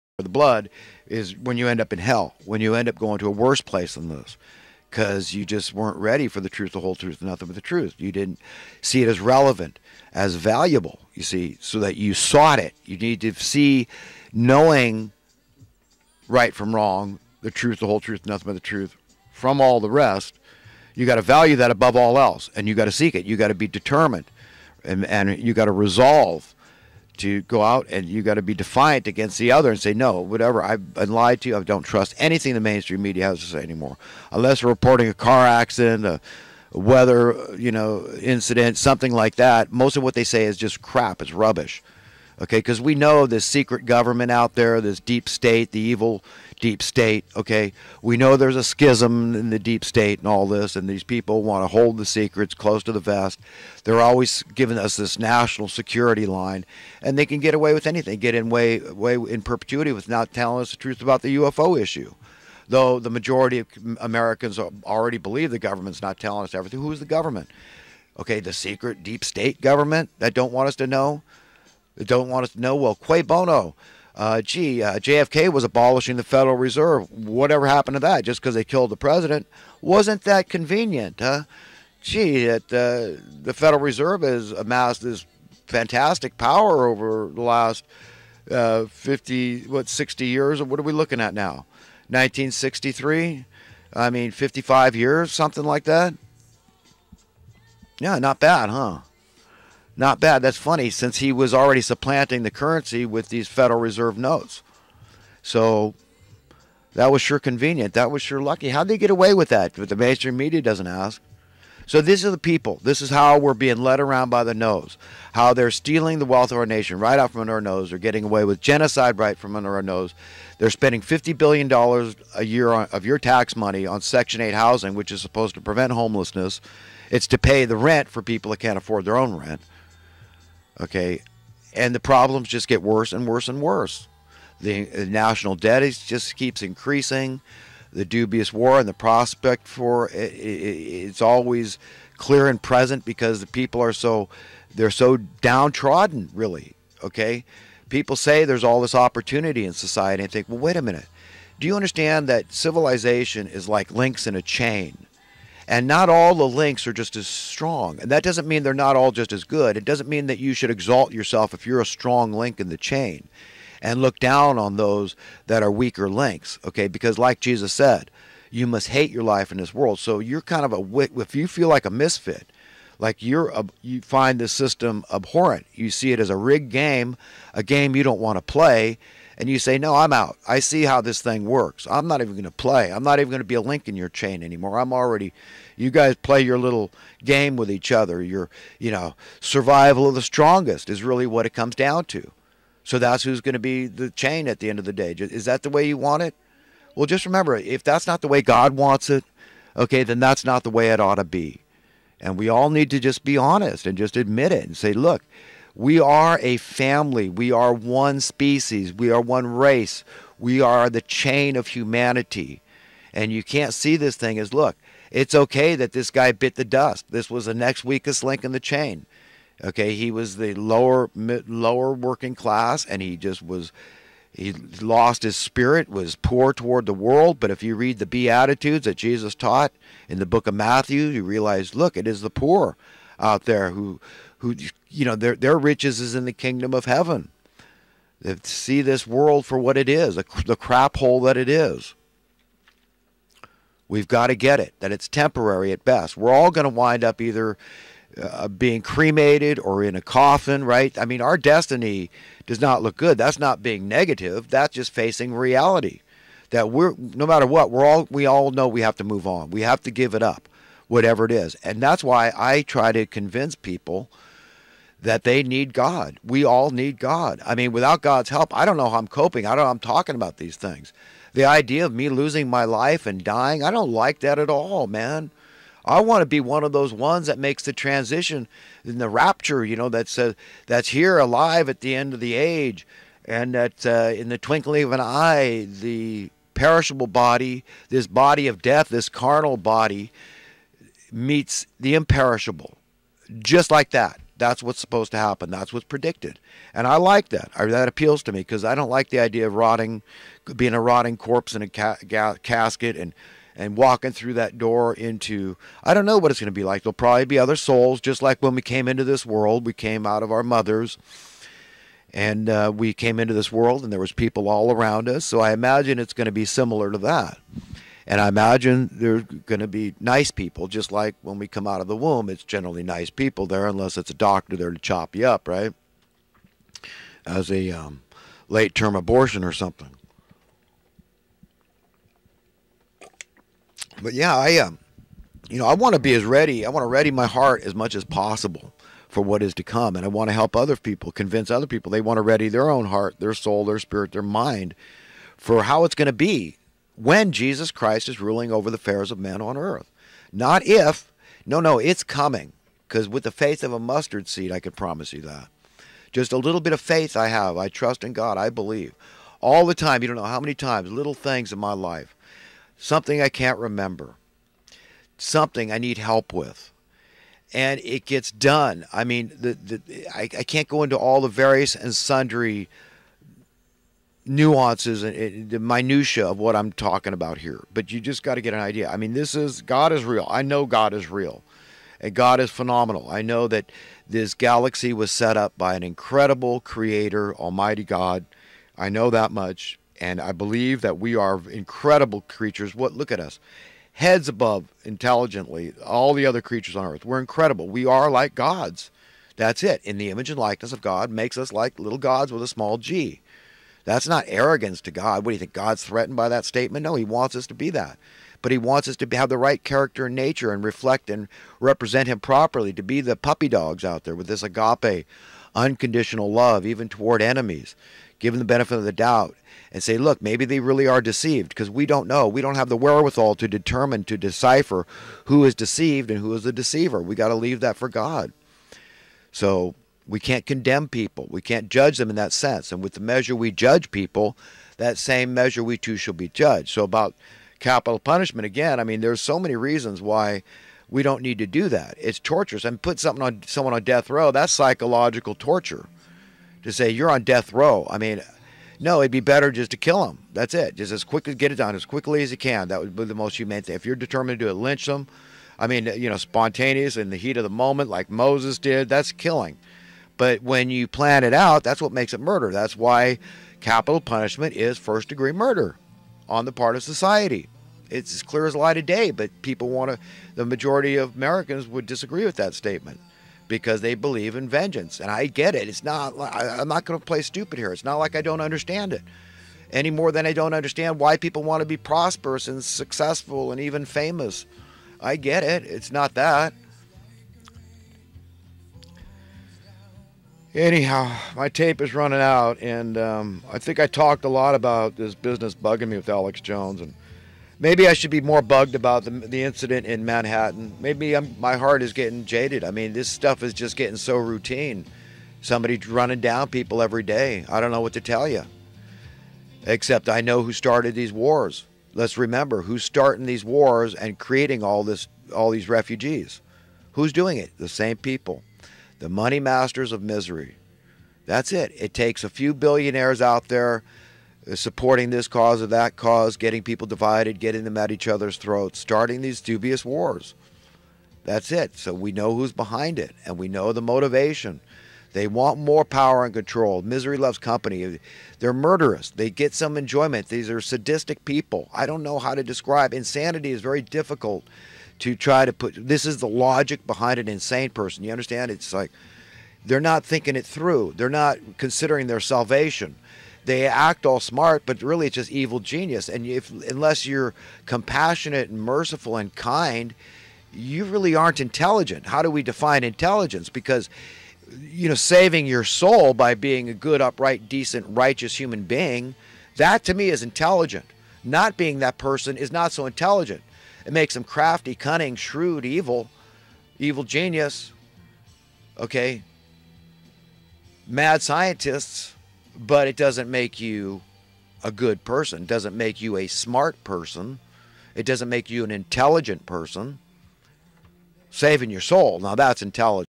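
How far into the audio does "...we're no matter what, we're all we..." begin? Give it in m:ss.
4:16.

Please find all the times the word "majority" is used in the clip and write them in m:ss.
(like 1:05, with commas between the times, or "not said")
1:03, 7:50.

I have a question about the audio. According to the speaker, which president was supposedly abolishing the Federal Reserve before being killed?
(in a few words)
JFK.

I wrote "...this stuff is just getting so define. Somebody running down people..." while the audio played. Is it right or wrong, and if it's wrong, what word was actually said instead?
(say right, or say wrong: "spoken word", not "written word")
wrong: "routine", not "define".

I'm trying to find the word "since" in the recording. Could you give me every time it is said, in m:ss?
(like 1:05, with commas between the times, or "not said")
1:40.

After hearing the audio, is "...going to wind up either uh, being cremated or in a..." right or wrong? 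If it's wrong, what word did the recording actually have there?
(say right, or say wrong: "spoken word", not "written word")
right.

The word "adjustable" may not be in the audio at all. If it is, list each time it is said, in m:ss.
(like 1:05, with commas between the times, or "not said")
not said.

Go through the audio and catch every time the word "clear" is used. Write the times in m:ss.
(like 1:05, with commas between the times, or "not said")
2:22, 7:48.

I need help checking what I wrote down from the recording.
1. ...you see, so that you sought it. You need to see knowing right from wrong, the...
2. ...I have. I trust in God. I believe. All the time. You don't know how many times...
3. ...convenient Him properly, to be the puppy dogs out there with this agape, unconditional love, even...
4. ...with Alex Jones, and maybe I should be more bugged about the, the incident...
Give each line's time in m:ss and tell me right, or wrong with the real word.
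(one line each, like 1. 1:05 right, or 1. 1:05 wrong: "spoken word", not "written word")
1. 0:11 right
2. 5:57 right
3. 6:51 wrong: "represent", not "convenient"
4. 8:15 right.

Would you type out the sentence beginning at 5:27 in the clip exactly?
As a um, late term abortion or something.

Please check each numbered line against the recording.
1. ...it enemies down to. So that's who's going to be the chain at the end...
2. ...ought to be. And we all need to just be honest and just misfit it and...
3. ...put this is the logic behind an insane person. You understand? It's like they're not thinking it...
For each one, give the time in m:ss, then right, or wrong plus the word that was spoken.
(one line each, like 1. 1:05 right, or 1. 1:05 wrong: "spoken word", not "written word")
1. 3:11 wrong: "comes", not "enemies"
2. 3:20 wrong: "admit", not "misfit"
3. 9:05 right.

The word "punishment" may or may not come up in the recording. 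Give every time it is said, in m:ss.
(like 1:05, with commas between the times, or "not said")
7:17, 7:43.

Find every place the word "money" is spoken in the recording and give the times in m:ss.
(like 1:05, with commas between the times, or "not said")
2:03, 8:39.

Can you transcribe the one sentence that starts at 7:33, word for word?
If you're determined to do it, lynch them.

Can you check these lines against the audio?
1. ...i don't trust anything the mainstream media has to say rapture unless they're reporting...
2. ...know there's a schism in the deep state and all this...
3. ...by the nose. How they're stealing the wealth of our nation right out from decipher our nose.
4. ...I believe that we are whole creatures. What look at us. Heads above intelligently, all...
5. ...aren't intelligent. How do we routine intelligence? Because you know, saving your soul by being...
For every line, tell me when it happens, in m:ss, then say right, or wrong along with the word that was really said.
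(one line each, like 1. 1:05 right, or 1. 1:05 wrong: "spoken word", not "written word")
1. 0:31 wrong: "anymore", not "rapture"
2. 0:48 right
3. 1:54 wrong: "under", not "decipher"
4. 6:30 wrong: "incredible", not "whole"
5. 9:21 wrong: "define", not "routine".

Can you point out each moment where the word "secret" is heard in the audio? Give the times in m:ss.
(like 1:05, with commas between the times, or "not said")
0:43, 0:52, 1:08.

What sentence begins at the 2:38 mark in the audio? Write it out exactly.
And that doesn't mean they're not all just as good.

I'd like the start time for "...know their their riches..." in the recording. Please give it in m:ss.
3:55.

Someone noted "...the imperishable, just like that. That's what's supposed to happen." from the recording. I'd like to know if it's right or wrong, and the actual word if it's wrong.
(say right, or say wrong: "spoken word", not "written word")
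right.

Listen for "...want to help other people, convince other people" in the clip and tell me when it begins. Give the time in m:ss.
5:40.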